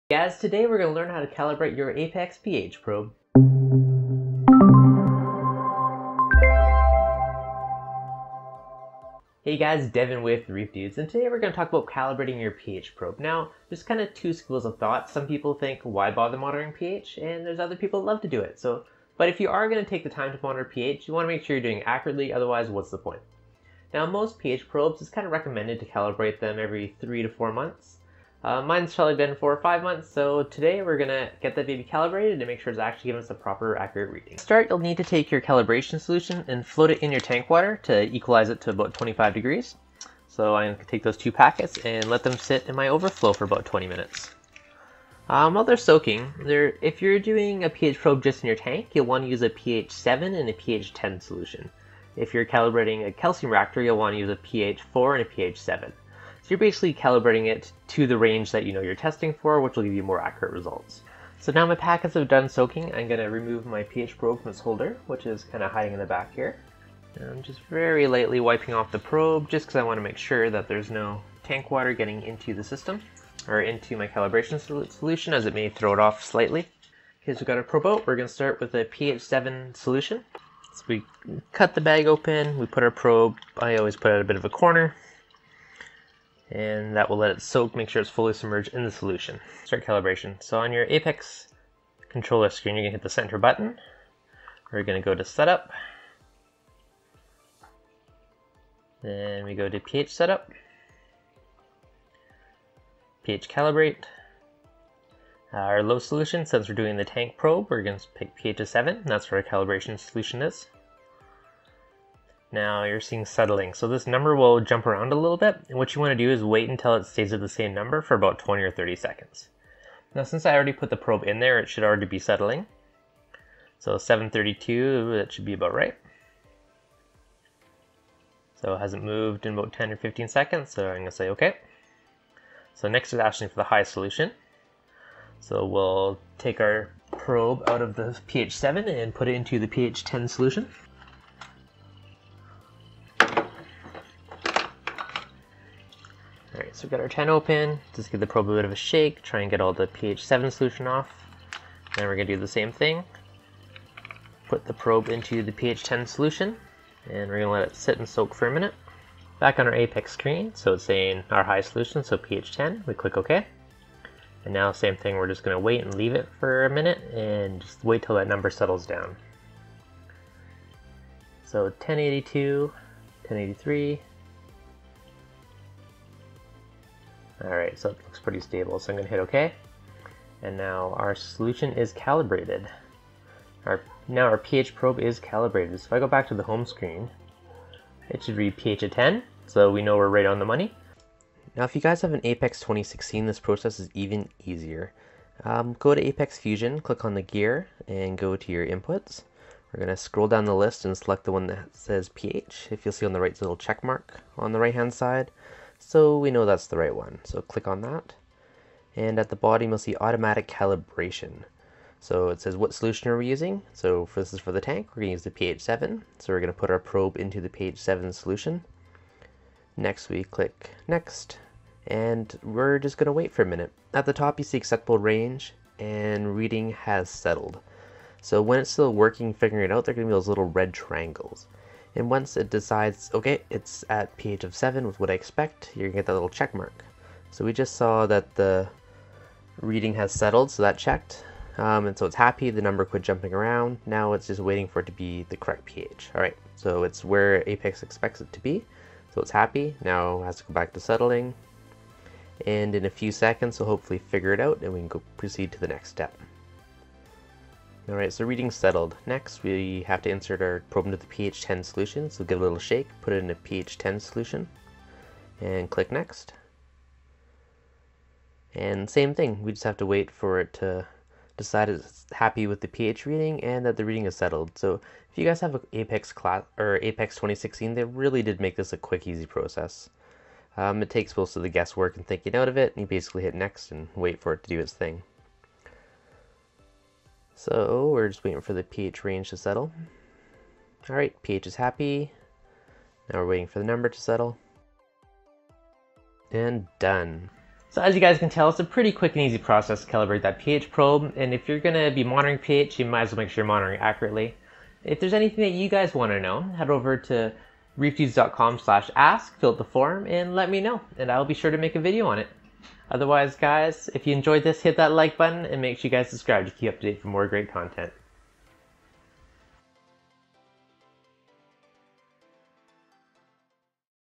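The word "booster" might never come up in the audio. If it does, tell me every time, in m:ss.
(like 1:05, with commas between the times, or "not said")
not said.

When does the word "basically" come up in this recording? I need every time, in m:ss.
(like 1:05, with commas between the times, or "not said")
0:56, 4:42.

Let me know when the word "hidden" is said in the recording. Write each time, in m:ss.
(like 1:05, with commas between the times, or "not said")
not said.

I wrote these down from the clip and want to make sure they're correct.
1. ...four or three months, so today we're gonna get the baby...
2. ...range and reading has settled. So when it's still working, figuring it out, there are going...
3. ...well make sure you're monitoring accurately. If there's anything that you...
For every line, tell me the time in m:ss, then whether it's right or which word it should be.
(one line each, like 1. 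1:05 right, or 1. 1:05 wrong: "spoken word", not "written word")
1. 0:29 wrong: "five", not "three"
2. 3:44 right
3. 5:03 right.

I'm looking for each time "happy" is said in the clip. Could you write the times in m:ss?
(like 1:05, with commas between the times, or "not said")
4:02, 4:09, 4:32, 4:51.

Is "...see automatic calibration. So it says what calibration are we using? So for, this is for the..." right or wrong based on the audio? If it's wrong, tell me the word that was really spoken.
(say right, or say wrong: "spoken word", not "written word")
wrong: "solution", not "calibration".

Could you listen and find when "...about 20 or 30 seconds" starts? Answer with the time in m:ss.
1:58.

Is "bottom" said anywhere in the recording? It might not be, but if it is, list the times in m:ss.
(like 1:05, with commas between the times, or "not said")
3:29.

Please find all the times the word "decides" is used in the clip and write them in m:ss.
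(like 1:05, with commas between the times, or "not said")
3:52, 4:31.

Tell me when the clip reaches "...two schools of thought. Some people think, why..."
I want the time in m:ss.
0:14.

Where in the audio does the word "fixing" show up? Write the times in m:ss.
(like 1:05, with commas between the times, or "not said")
not said.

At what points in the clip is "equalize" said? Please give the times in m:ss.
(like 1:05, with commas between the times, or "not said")
0:38.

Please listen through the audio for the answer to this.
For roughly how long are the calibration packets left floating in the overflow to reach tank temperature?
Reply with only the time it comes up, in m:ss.
0:43.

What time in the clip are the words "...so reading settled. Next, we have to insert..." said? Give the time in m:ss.
4:18.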